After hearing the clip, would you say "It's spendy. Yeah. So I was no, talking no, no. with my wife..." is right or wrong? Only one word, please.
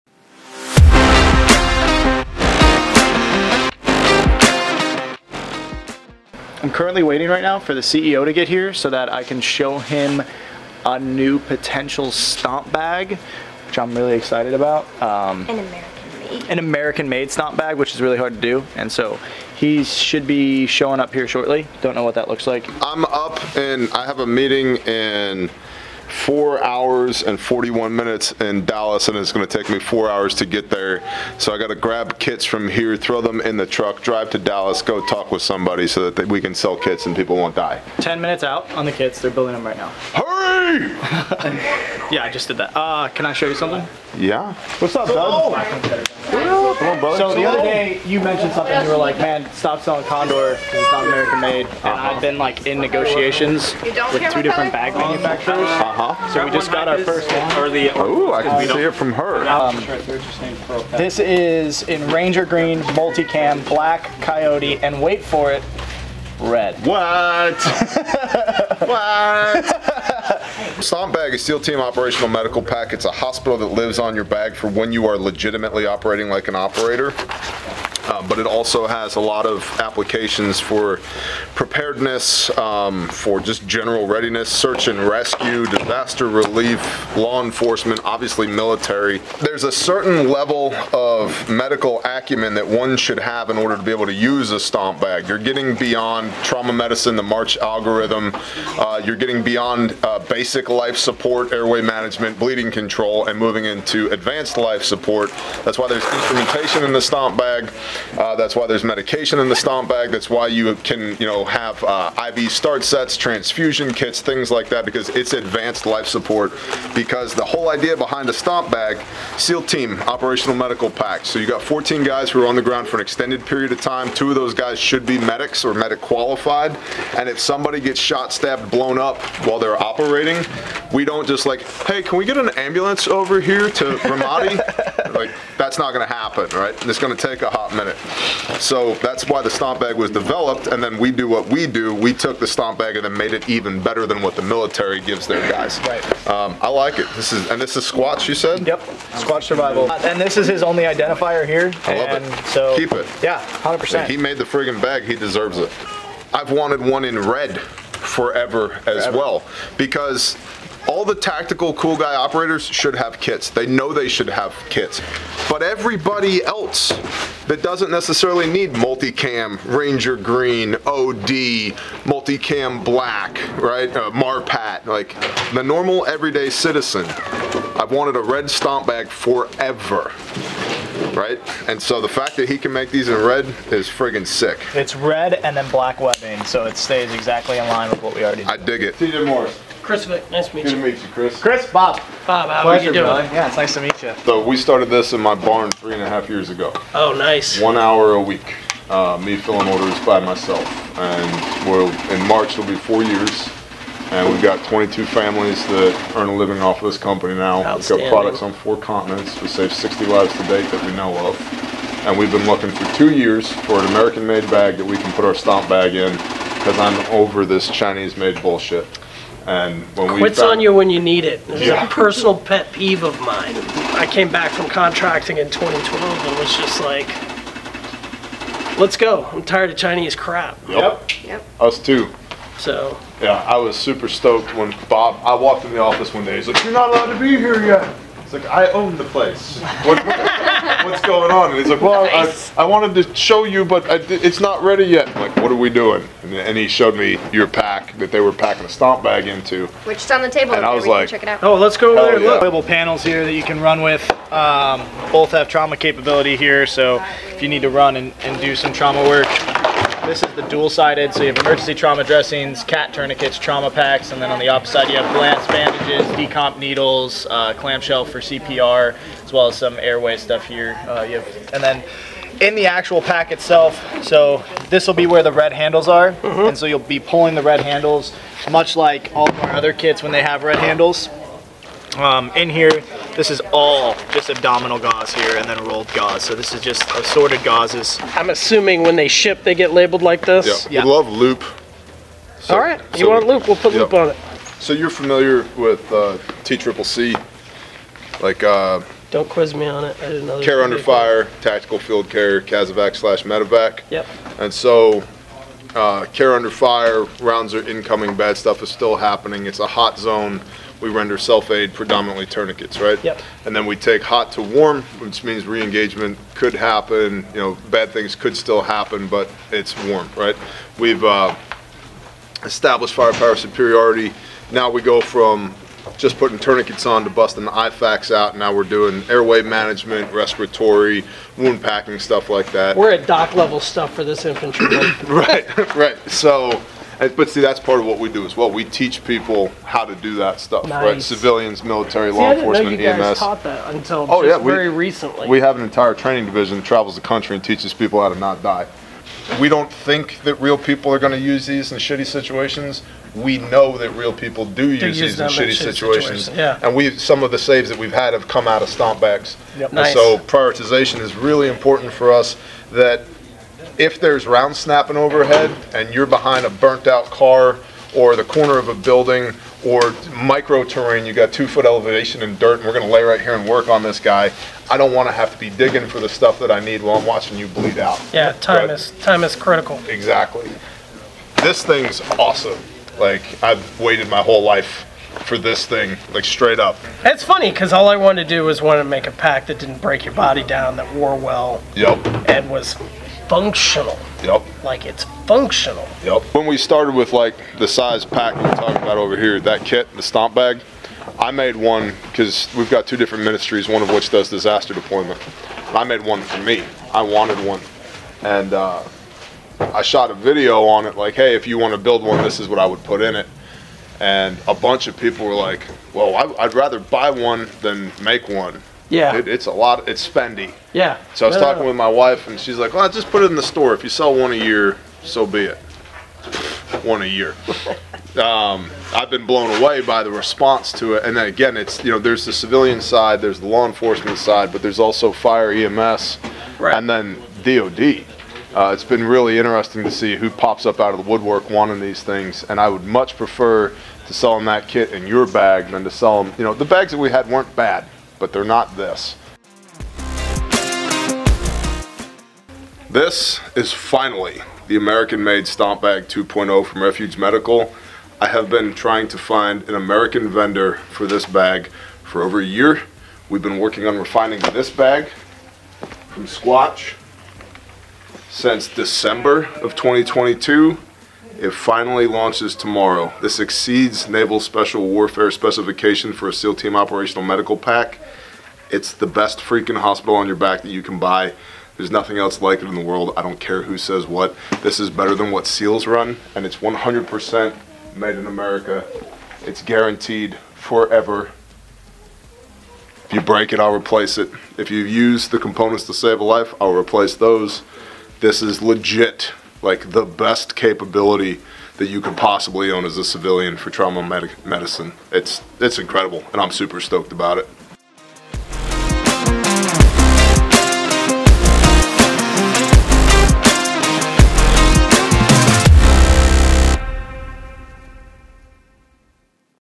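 right.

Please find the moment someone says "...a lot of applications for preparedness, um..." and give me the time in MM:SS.
01:19.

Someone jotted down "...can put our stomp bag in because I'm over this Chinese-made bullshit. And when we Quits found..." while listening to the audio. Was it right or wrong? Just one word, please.
right.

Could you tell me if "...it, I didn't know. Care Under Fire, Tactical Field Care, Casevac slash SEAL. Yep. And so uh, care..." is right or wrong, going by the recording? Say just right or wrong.
wrong.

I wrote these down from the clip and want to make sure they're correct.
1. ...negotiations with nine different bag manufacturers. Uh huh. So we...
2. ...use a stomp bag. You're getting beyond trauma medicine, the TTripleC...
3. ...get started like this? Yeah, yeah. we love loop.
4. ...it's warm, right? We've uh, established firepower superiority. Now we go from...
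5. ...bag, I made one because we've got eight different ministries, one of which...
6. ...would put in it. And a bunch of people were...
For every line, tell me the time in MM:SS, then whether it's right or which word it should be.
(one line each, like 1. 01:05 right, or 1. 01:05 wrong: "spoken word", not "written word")
1. 00:52 wrong: "two", not "nine"
2. 01:34 wrong: "March", not "TTripleC"
3. 04:49 wrong: "labeled", not "started"
4. 05:19 right
5. 06:40 wrong: "two", not "eight"
6. 06:52 right.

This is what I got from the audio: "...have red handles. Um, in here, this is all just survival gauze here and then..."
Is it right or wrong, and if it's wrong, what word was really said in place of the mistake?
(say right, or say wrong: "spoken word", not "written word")
wrong: "abdominal", not "survival".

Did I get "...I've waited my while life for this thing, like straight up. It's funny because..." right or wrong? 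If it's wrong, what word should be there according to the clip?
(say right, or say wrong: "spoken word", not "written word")
wrong: "whole", not "while".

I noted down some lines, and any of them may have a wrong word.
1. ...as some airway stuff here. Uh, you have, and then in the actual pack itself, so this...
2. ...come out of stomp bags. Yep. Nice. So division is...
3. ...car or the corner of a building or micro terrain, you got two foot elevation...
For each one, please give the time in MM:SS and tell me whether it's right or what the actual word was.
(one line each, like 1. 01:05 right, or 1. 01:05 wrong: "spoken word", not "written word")
1. 04:29 right
2. 05:58 wrong: "prioritization", not "division"
3. 06:07 right.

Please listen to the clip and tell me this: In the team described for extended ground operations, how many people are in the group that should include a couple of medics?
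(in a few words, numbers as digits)
14.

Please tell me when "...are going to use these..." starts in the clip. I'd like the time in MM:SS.
05:50.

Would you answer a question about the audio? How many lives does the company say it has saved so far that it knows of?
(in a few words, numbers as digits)
60.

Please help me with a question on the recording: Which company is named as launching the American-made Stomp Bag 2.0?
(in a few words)
Refuge Medical.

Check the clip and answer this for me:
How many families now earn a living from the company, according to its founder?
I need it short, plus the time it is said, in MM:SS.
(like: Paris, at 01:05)
22, at 03:24.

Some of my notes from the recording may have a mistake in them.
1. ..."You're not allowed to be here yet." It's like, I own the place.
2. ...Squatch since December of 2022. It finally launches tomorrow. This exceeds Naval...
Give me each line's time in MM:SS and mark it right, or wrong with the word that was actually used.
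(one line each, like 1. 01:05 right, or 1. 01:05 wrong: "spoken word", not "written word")
1. 03:56 right
2. 07:46 right.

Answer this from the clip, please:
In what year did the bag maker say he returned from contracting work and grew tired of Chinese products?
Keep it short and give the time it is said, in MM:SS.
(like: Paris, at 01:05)
2012, at 03:45.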